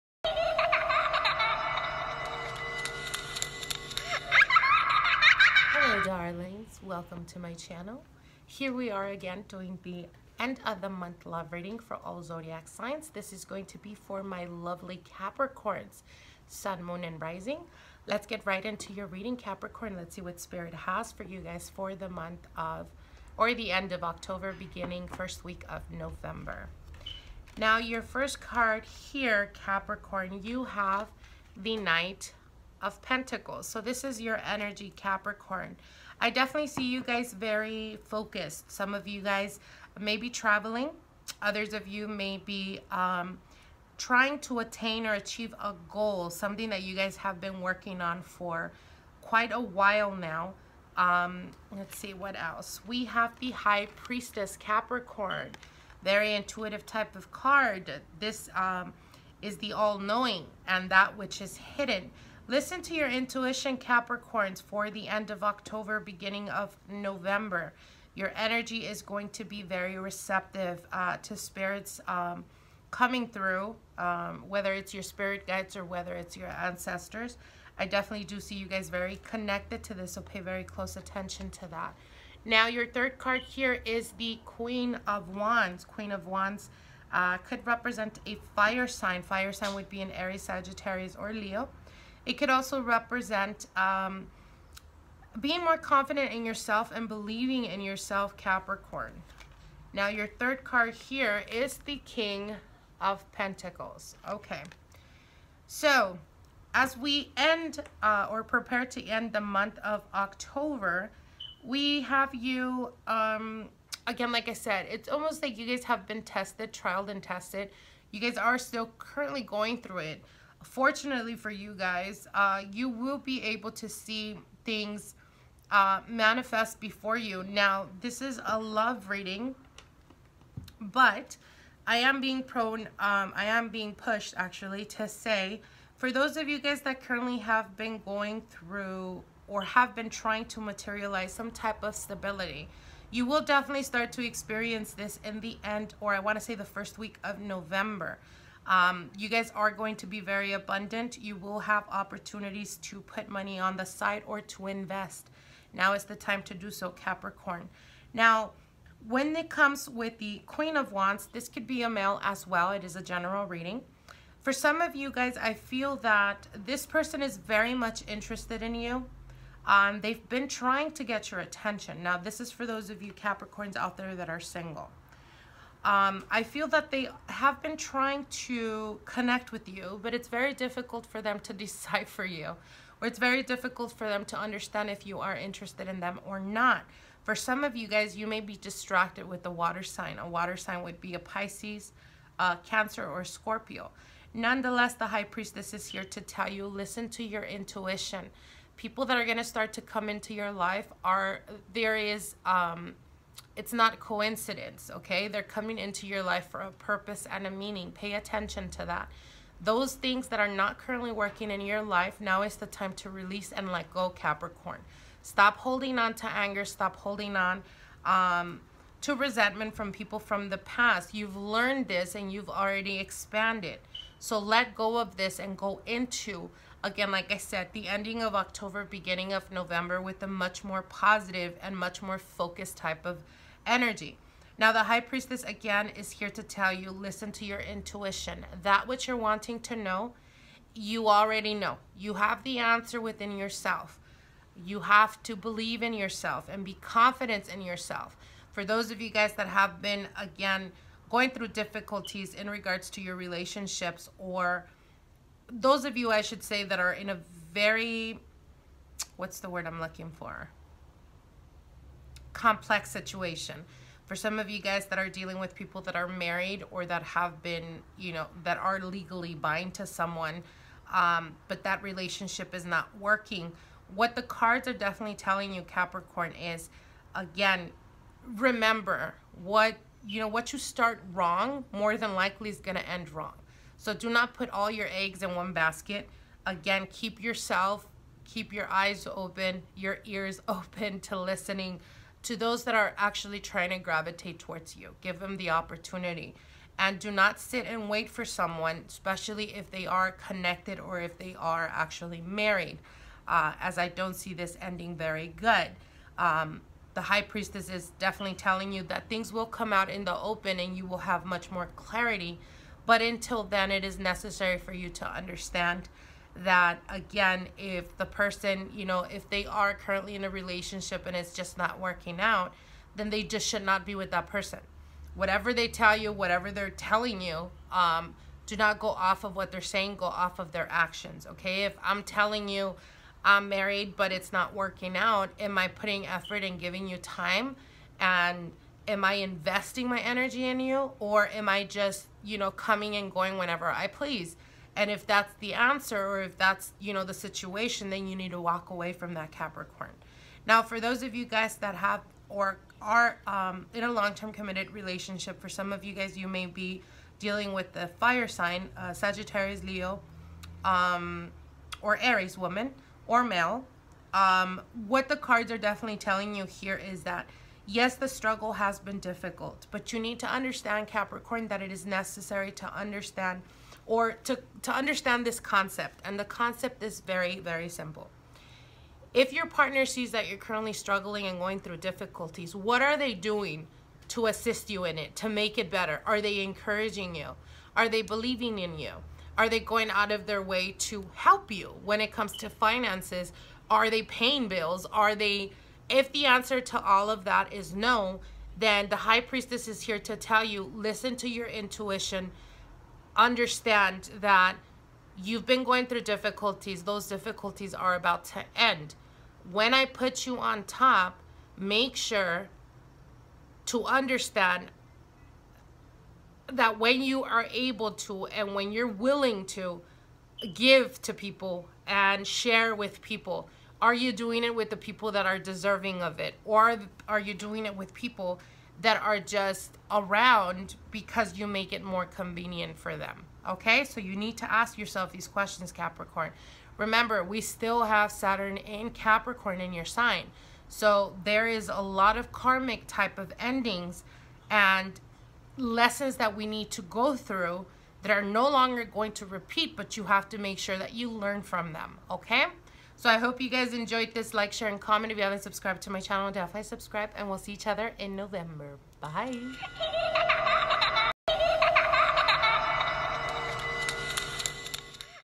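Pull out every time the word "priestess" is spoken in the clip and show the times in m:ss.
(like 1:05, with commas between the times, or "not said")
0:53, 3:15, 3:54, 5:07, 6:39.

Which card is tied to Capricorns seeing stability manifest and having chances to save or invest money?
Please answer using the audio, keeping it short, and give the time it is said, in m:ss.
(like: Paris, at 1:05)
King of Pentacles, at 1:42.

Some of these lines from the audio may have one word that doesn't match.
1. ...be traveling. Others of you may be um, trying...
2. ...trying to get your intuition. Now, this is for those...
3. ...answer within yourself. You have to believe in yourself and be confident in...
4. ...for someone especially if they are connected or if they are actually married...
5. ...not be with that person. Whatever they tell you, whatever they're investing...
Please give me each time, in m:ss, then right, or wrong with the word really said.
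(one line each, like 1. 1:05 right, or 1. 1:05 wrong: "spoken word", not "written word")
1. 0:40 right
2. 2:50 wrong: "attention", not "intuition"
3. 4:02 right
4. 4:58 right
5. 5:23 wrong: "telling", not "investing".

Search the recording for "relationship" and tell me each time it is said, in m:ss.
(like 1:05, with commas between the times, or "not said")
4:13, 4:31, 5:20, 5:54.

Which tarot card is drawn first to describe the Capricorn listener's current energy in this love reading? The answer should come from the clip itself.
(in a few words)
Knight of Pentacles.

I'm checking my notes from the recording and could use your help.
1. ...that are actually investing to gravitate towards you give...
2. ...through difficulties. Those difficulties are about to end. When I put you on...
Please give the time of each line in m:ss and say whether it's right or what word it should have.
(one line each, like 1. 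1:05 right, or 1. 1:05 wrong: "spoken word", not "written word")
1. 4:52 wrong: "trying", not "investing"
2. 6:45 right.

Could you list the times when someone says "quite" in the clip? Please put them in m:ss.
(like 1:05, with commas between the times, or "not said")
0:49.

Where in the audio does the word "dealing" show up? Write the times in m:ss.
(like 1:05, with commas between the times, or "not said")
4:25, 5:57.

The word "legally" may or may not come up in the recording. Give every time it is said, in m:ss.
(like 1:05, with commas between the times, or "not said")
4:28.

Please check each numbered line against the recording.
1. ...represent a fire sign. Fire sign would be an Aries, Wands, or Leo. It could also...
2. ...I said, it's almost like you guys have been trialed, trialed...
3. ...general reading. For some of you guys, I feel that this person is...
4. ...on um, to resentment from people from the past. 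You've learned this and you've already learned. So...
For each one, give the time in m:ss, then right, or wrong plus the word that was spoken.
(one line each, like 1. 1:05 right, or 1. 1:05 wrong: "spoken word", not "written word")
1. 1:27 wrong: "Sagittarius", not "Wands"
2. 1:54 wrong: "tested", not "trialed"
3. 2:43 right
4. 3:37 wrong: "expanded", not "learned".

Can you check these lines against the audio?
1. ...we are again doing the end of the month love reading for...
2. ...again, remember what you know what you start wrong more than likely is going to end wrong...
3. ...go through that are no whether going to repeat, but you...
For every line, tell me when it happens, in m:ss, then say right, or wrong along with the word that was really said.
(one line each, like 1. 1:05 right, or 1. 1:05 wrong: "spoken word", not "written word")
1. 0:08 right
2. 4:37 right
3. 7:26 wrong: "longer", not "whether".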